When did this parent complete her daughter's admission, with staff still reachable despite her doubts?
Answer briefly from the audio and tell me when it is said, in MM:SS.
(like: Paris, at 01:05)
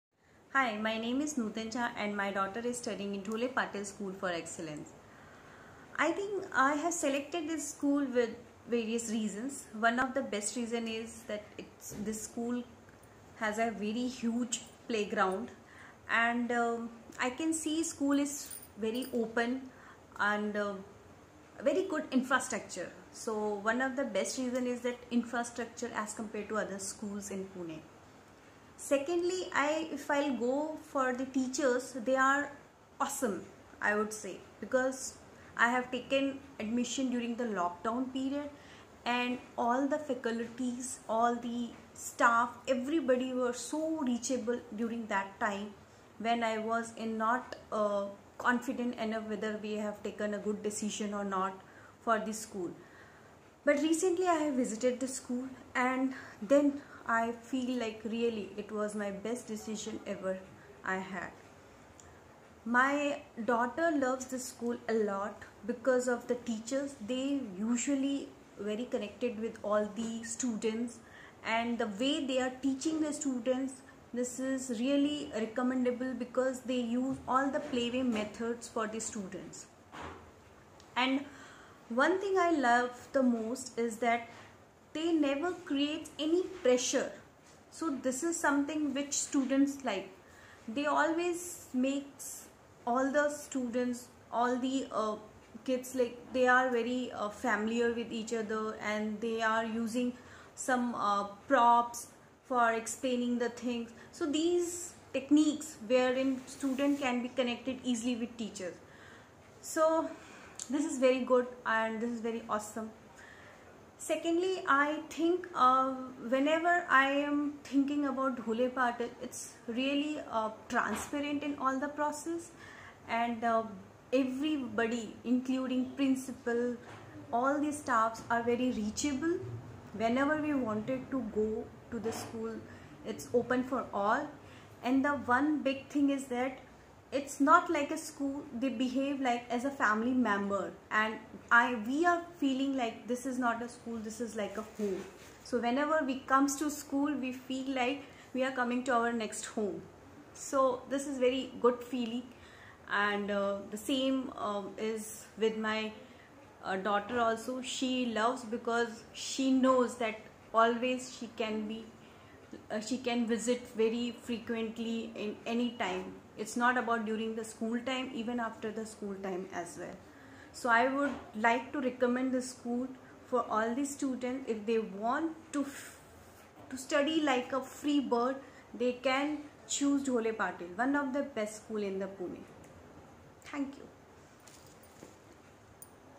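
lockdown period, at 00:37.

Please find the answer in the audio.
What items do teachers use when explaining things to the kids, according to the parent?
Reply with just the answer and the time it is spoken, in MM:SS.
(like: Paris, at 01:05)
props, at 01:41.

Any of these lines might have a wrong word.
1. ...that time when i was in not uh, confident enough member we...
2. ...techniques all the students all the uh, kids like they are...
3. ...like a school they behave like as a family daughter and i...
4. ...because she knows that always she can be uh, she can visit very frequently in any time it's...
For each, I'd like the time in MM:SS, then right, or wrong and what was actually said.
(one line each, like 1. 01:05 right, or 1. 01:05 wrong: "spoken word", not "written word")
1. 00:45 wrong: "whether", not "member"
2. 01:31 wrong: "makes", not "techniques"
3. 02:17 wrong: "member", not "daughter"
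4. 02:38 right.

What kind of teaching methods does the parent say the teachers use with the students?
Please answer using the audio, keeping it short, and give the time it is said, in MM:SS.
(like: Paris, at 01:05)
playway methods, at 01:17.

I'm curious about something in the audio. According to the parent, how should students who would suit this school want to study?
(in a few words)
a free bird.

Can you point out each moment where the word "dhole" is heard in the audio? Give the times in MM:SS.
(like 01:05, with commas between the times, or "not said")
00:03, 01:58, 03:00.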